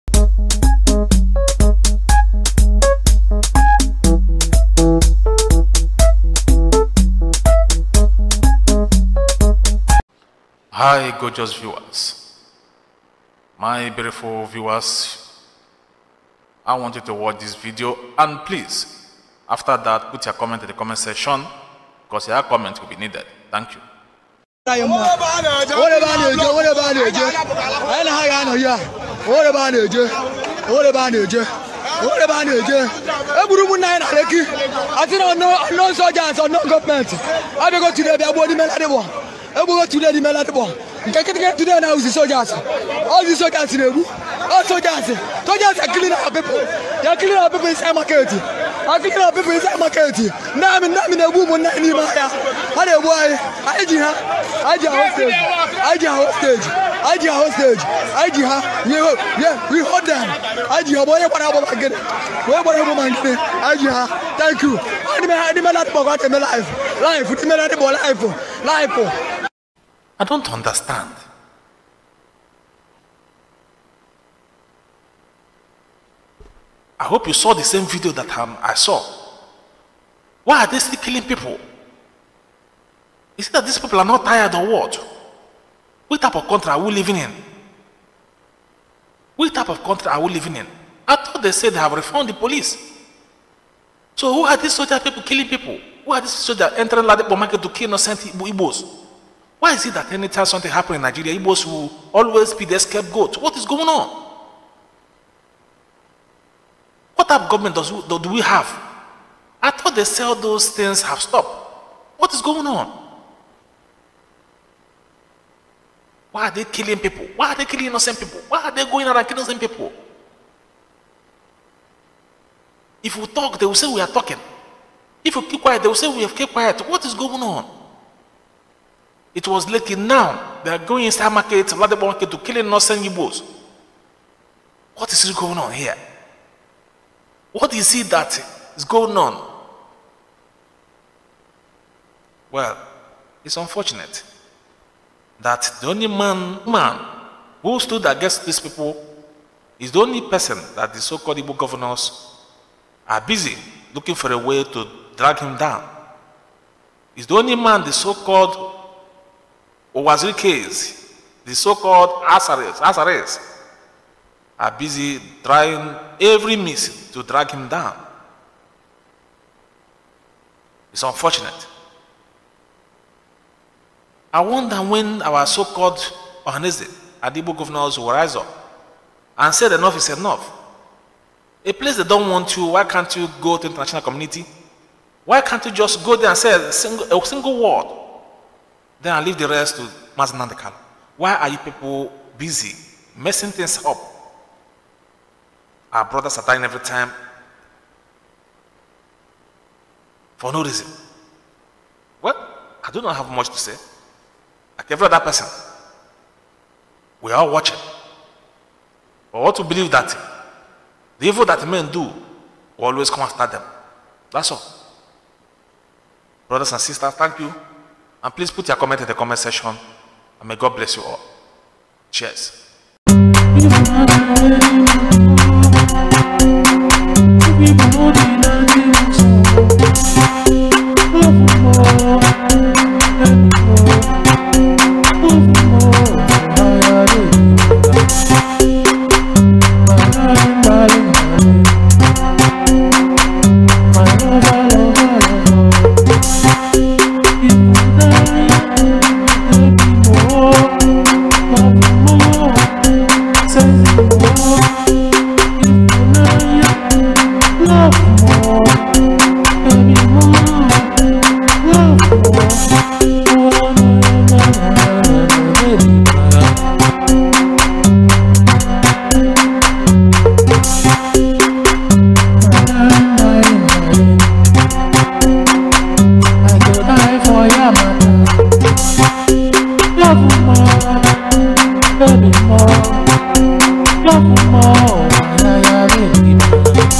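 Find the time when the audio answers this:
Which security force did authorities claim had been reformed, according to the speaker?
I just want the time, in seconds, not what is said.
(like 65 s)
92 s.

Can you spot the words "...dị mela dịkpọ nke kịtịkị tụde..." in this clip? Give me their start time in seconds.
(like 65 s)
40 s.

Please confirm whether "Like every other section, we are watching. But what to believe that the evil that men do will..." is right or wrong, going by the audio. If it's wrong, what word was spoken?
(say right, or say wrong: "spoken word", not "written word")
wrong: "person", not "section".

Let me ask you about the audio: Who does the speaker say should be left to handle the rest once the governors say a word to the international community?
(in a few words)
Mazi Nnamdi Kanu.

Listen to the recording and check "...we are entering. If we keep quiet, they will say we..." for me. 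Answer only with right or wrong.
wrong.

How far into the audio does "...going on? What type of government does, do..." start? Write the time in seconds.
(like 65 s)
103 s.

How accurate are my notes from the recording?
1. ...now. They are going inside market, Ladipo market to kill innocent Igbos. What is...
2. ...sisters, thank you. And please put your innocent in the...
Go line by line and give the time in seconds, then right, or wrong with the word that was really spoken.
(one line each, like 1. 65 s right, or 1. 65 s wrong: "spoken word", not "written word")
1. 129 s right
2. 216 s wrong: "comment", not "innocent".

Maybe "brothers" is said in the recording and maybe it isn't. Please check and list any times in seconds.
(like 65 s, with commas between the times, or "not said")
196 s, 216 s.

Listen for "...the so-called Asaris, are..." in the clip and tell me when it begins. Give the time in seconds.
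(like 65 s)
161 s.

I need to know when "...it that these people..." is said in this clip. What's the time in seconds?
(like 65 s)
83 s.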